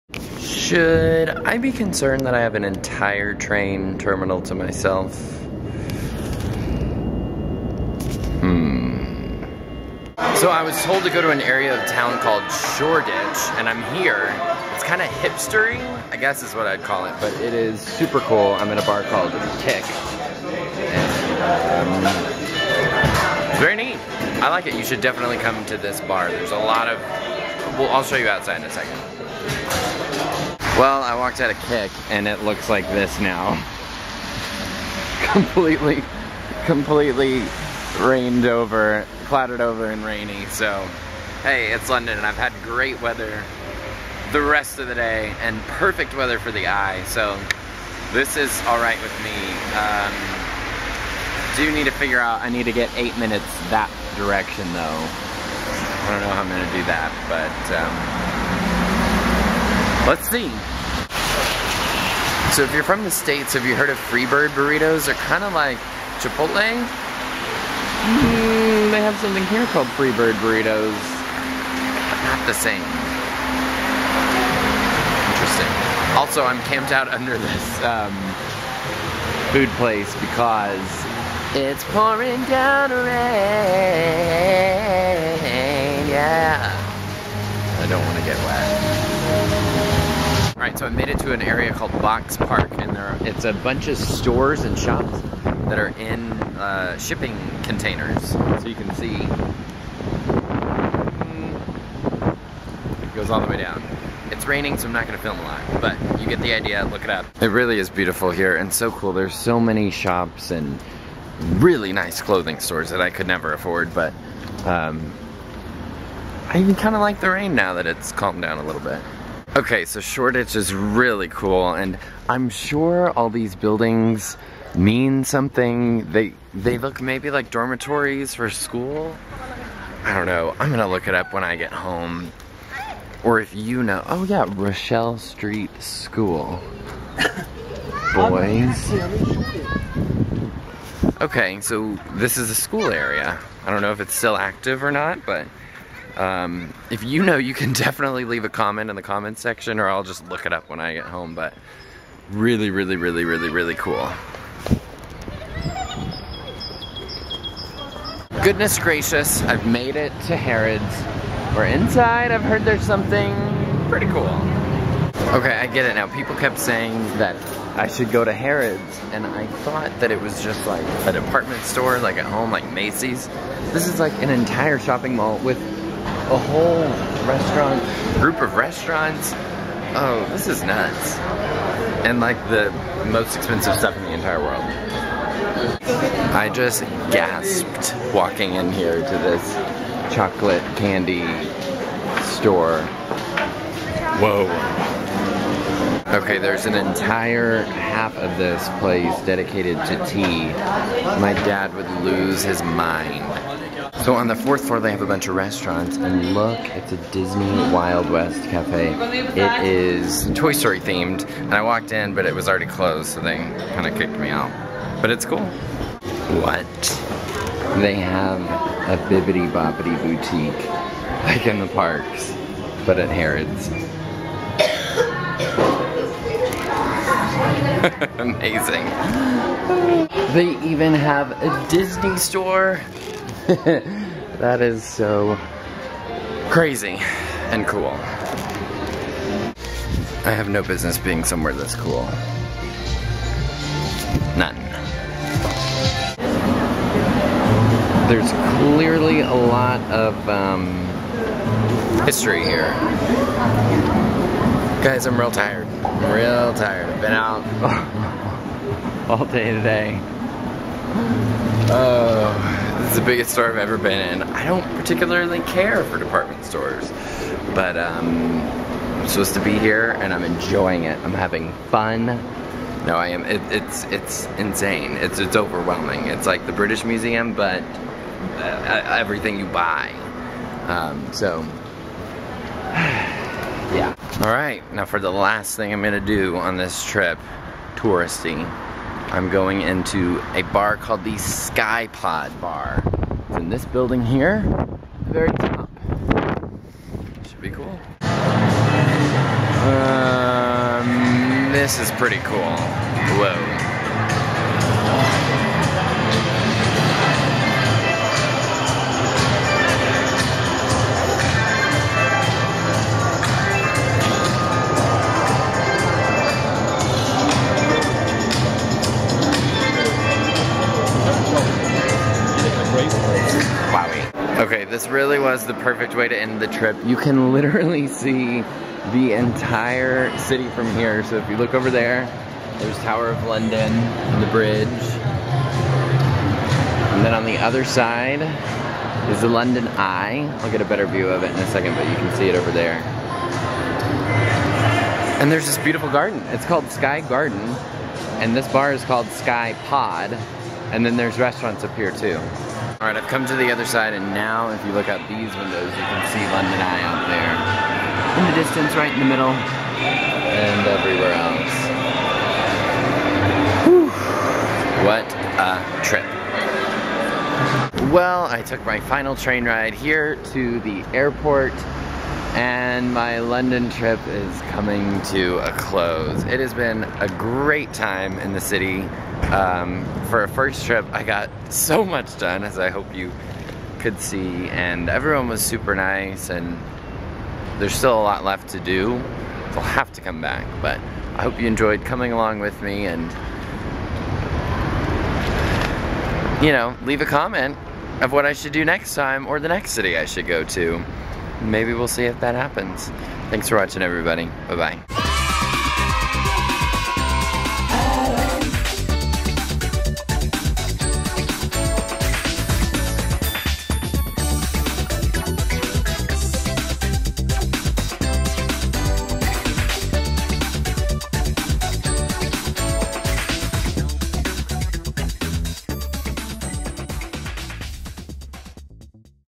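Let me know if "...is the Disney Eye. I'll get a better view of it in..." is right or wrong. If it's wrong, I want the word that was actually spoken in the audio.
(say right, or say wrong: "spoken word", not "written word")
wrong: "London", not "Disney".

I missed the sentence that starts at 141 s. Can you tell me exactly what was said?
Okay, so this is a school area.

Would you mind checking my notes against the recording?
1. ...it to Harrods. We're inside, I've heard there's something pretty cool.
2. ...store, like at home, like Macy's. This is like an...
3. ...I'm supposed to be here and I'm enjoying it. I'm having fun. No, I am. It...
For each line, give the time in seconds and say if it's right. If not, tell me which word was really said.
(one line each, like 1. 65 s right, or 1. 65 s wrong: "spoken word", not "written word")
1. 159 s right
2. 171 s right
3. 268 s right.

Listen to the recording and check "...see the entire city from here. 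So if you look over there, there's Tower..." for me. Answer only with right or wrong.
right.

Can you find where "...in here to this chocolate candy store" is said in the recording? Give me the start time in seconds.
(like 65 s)
188 s.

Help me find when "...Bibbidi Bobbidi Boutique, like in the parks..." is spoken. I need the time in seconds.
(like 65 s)
219 s.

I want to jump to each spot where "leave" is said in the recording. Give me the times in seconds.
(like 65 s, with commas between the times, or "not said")
148 s, 396 s.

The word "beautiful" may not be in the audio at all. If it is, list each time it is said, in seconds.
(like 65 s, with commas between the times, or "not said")
107 s, 345 s.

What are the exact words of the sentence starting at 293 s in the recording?
It's in this building here, the very top.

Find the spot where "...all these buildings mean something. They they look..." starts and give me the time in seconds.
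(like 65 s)
123 s.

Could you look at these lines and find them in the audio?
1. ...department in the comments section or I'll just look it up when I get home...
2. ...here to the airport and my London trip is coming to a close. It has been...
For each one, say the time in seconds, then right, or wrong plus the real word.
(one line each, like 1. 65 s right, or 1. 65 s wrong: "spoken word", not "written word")
1. 148 s wrong: "comment", not "department"
2. 369 s right.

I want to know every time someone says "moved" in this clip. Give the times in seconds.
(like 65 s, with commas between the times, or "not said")
not said.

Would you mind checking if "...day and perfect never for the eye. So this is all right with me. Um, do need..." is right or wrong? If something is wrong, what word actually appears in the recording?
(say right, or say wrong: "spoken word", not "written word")
wrong: "weather", not "never".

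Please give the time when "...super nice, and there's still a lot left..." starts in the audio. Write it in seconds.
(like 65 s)
385 s.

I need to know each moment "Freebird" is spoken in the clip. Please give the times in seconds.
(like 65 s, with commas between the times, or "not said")
63 s, 69 s.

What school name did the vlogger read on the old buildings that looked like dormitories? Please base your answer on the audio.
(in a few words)
Rochelle Street School.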